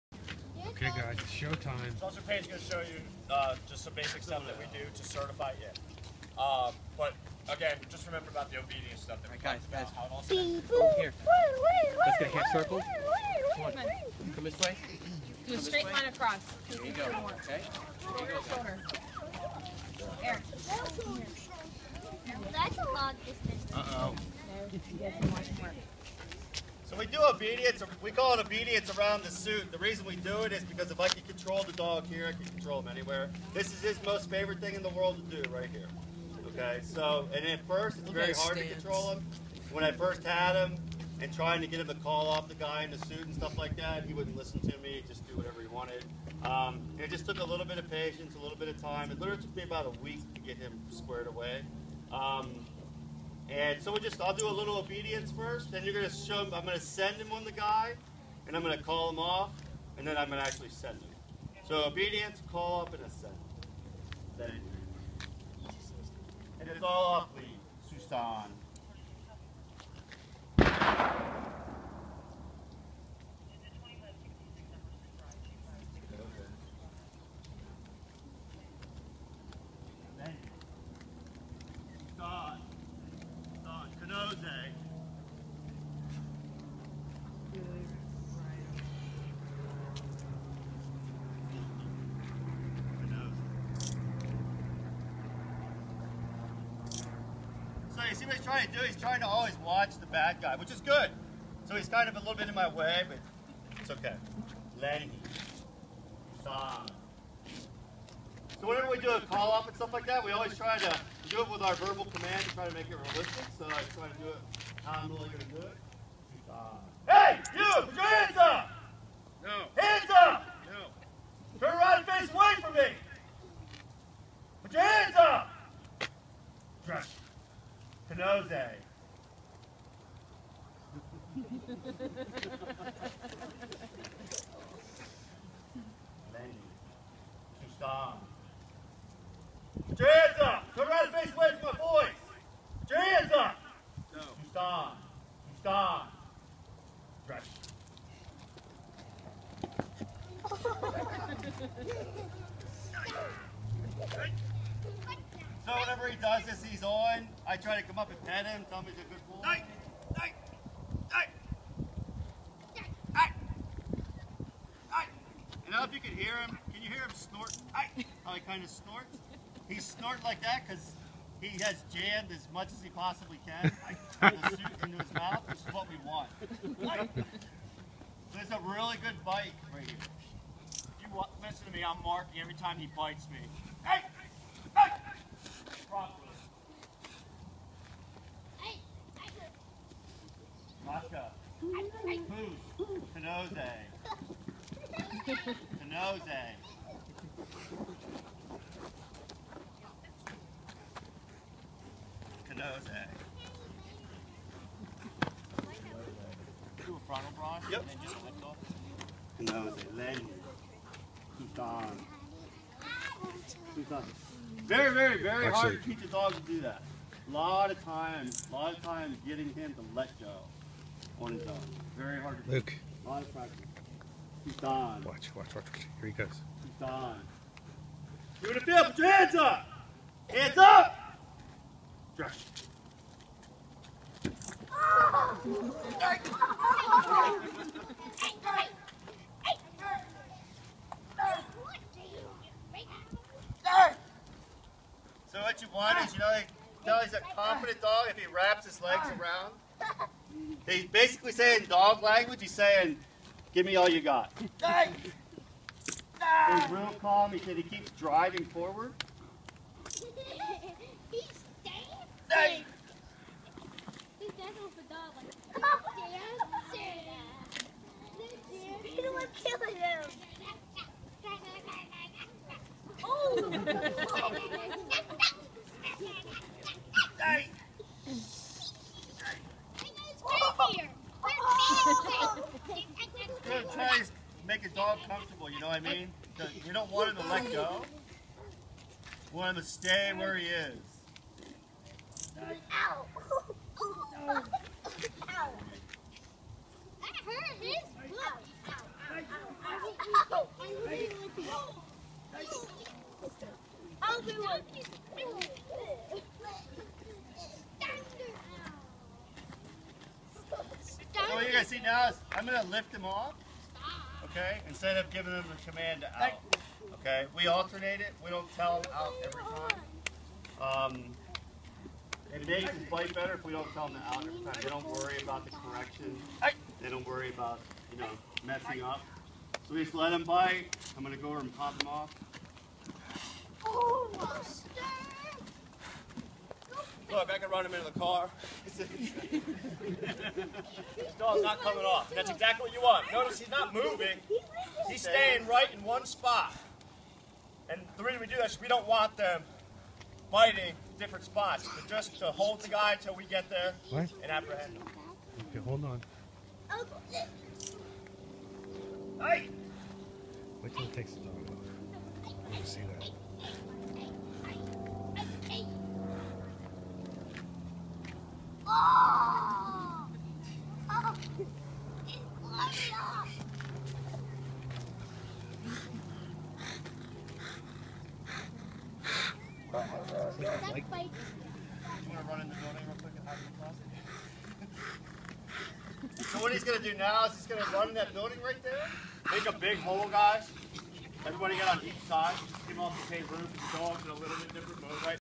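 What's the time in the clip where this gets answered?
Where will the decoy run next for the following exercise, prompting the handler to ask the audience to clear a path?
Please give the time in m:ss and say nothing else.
6:27.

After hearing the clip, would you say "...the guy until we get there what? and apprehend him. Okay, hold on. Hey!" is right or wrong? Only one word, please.
right.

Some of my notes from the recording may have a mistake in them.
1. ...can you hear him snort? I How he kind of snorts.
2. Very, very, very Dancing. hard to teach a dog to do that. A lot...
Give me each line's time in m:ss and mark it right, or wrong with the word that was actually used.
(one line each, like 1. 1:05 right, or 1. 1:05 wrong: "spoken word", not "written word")
1. 2:46 right
2. 3:34 wrong: "Actually", not "Dancing".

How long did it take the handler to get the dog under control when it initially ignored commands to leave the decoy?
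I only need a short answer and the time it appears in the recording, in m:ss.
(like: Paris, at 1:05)
about a week, at 0:49.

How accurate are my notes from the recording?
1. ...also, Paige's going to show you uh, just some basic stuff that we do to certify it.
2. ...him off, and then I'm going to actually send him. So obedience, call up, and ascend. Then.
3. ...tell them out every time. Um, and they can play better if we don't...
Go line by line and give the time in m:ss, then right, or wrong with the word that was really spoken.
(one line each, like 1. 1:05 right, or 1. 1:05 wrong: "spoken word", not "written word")
1. 0:02 right
2. 0:59 right
3. 5:18 right.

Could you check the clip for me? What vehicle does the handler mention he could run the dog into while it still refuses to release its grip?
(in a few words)
the car.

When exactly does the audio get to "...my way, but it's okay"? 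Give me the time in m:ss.
1:42.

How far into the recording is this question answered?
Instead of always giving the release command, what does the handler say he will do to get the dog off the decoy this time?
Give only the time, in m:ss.
5:12.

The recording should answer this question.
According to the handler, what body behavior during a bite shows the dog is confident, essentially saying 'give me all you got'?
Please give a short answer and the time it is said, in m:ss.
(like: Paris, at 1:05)
wraps his legs around, at 4:08.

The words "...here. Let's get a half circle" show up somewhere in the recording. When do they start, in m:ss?
0:10.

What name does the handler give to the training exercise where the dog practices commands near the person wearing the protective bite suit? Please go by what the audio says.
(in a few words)
obedience around the suit.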